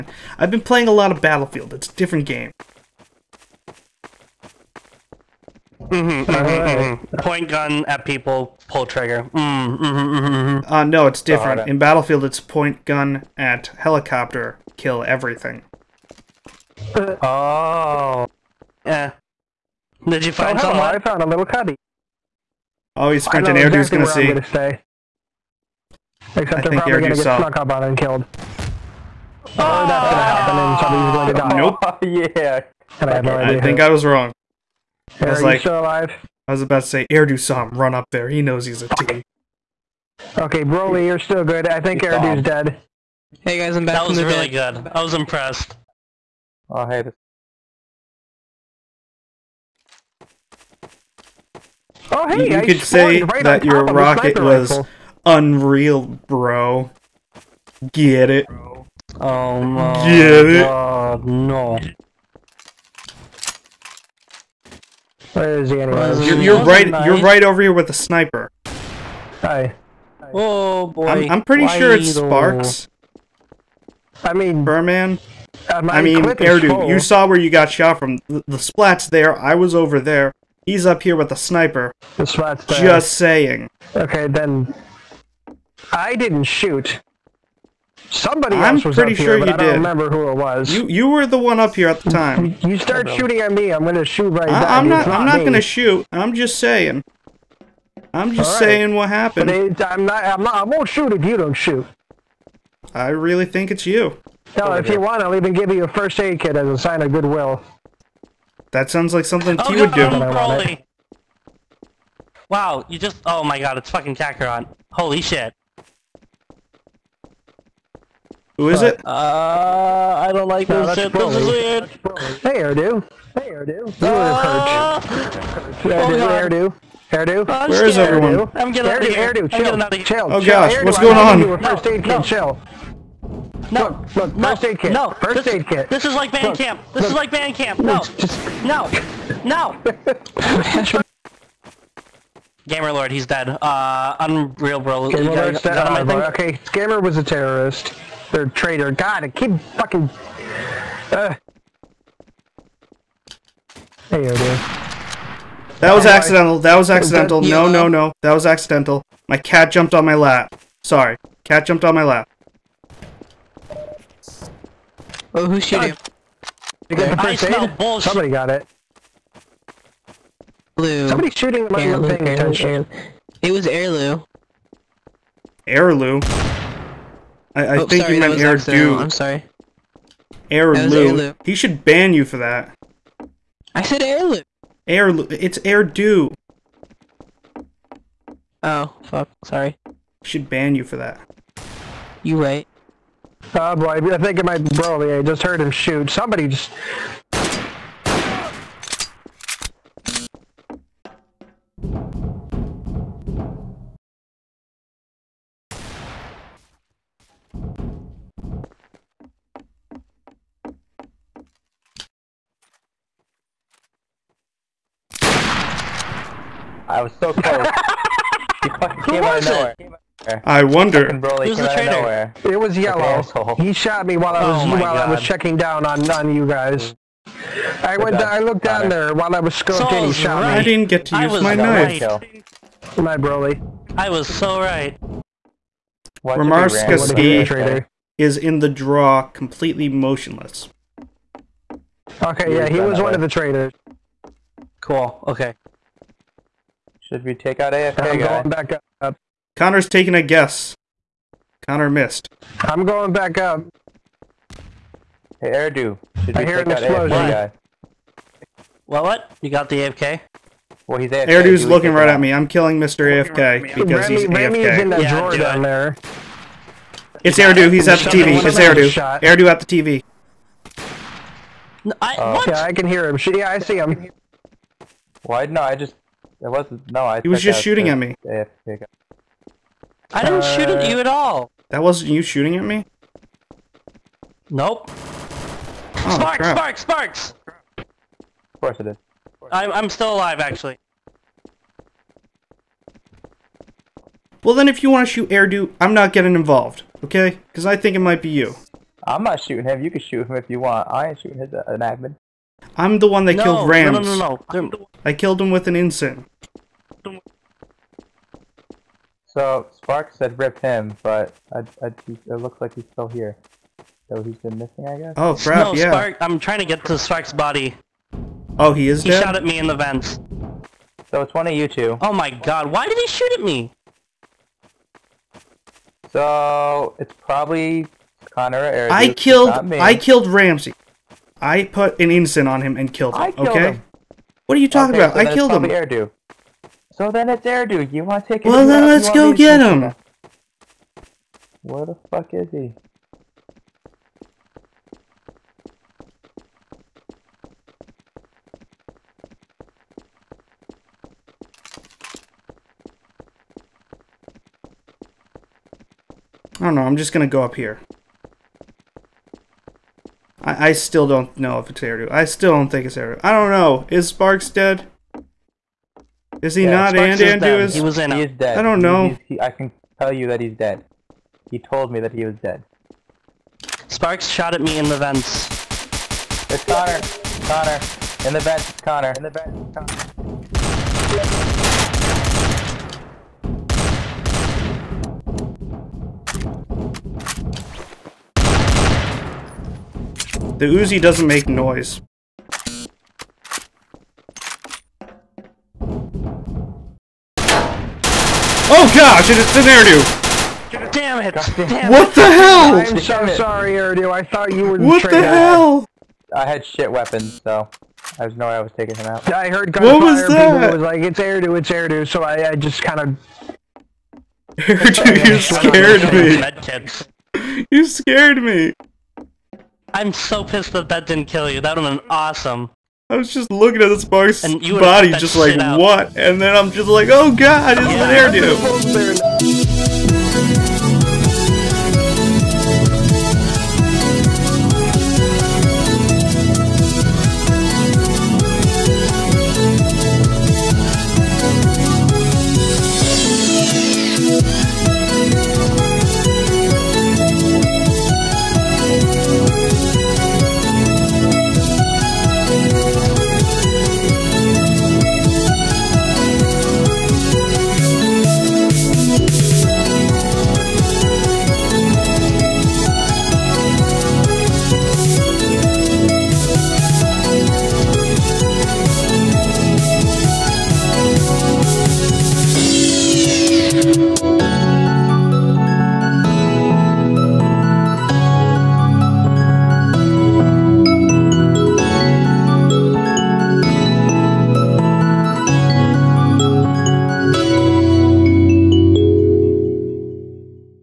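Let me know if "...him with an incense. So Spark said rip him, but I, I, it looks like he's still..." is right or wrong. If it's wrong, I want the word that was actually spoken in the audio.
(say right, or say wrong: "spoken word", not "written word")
right.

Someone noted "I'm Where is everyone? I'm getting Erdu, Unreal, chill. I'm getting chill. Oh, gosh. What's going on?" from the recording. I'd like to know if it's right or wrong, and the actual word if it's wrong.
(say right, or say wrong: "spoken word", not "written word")
wrong: "Erdu", not "Unreal".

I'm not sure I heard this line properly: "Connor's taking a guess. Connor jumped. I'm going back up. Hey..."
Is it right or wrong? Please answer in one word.
wrong.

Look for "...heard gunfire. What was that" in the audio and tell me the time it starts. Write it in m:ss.
6:49.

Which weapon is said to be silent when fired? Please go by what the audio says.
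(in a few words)
The Uzi.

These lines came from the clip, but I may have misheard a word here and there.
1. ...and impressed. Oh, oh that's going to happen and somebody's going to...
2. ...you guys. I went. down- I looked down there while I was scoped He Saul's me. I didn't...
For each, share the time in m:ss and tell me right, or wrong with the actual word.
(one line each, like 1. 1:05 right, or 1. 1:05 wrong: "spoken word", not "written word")
1. 0:27 wrong: "killed", not "impressed"
2. 3:46 right.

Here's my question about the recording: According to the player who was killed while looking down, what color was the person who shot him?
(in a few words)
Yellow.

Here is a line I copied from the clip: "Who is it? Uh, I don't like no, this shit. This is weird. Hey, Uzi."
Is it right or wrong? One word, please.
wrong.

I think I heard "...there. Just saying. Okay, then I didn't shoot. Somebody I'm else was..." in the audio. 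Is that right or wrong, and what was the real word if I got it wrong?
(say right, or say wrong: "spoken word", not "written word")
right.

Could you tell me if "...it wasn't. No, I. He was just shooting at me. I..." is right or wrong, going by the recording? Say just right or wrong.
right.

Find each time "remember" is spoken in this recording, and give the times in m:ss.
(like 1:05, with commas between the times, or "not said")
1:29.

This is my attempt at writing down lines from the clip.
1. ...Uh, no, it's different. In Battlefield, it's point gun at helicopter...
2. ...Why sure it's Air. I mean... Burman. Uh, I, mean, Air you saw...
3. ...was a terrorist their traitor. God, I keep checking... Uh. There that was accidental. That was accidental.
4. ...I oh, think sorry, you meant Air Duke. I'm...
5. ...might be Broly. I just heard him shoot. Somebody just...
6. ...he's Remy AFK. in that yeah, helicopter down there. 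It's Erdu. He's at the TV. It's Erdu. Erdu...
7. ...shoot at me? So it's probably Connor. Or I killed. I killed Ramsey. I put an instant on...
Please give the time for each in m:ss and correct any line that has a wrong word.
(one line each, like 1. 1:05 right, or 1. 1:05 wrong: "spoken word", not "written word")
1. 0:10 right
2. 1:11 wrong: "Sparks", not "Air"
3. 2:26 wrong: "fucking", not "checking"
4. 2:57 right
5. 3:14 right
6. 4:24 wrong: "drawer", not "helicopter"
7. 5:23 right.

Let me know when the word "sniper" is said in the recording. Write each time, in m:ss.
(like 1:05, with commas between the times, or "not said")
1:07, 1:21.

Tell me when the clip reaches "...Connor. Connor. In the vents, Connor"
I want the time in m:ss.
6:16.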